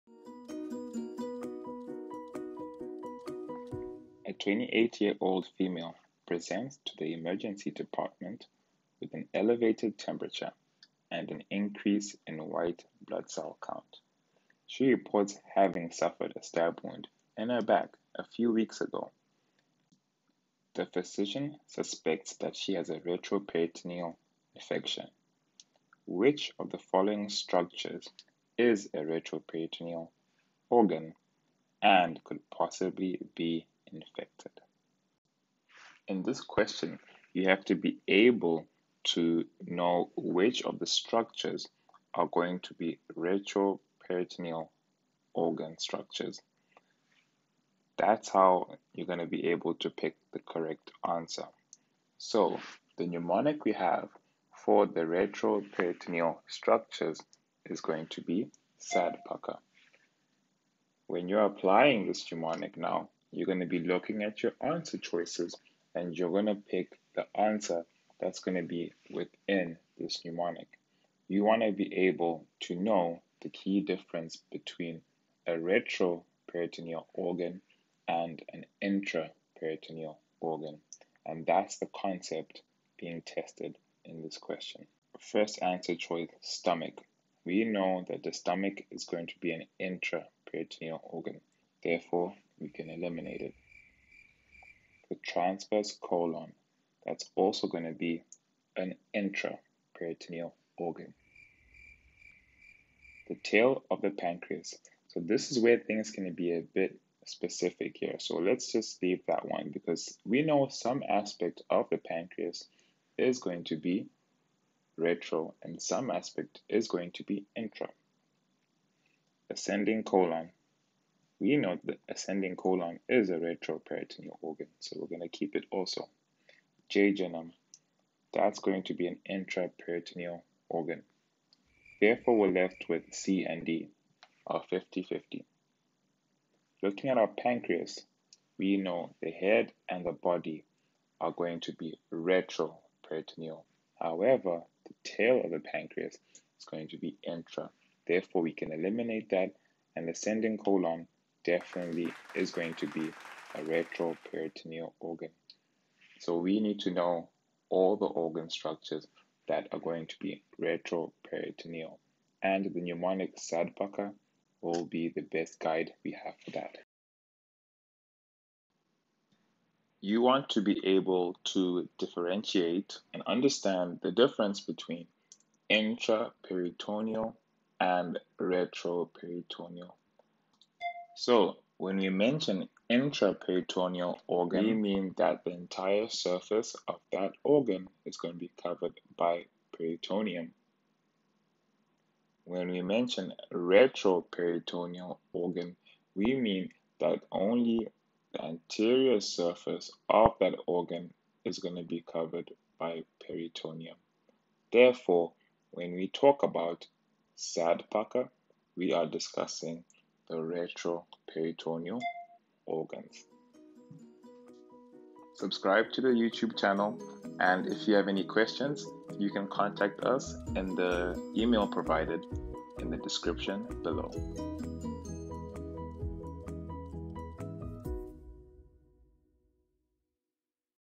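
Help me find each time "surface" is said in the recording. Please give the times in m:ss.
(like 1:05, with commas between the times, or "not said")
3:06, 3:19.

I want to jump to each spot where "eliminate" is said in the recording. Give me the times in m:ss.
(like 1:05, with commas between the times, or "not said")
1:32, 2:28.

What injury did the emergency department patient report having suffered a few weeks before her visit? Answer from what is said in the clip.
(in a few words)
Stab wound in her back.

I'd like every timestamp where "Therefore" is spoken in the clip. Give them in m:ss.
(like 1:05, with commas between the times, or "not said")
1:31, 2:11, 2:28, 3:24.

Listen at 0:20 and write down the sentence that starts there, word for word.
The physician suspects that she has a retroperitoneal infection.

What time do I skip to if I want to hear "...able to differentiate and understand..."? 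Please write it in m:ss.
2:50.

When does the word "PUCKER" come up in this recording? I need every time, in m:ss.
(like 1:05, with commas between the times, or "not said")
0:59, 2:43, 3:27.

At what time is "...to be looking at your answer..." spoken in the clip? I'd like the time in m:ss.
1:03.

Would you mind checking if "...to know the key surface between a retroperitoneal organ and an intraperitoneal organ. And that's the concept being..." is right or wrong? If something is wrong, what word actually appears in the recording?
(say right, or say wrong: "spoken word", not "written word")
wrong: "difference", not "surface".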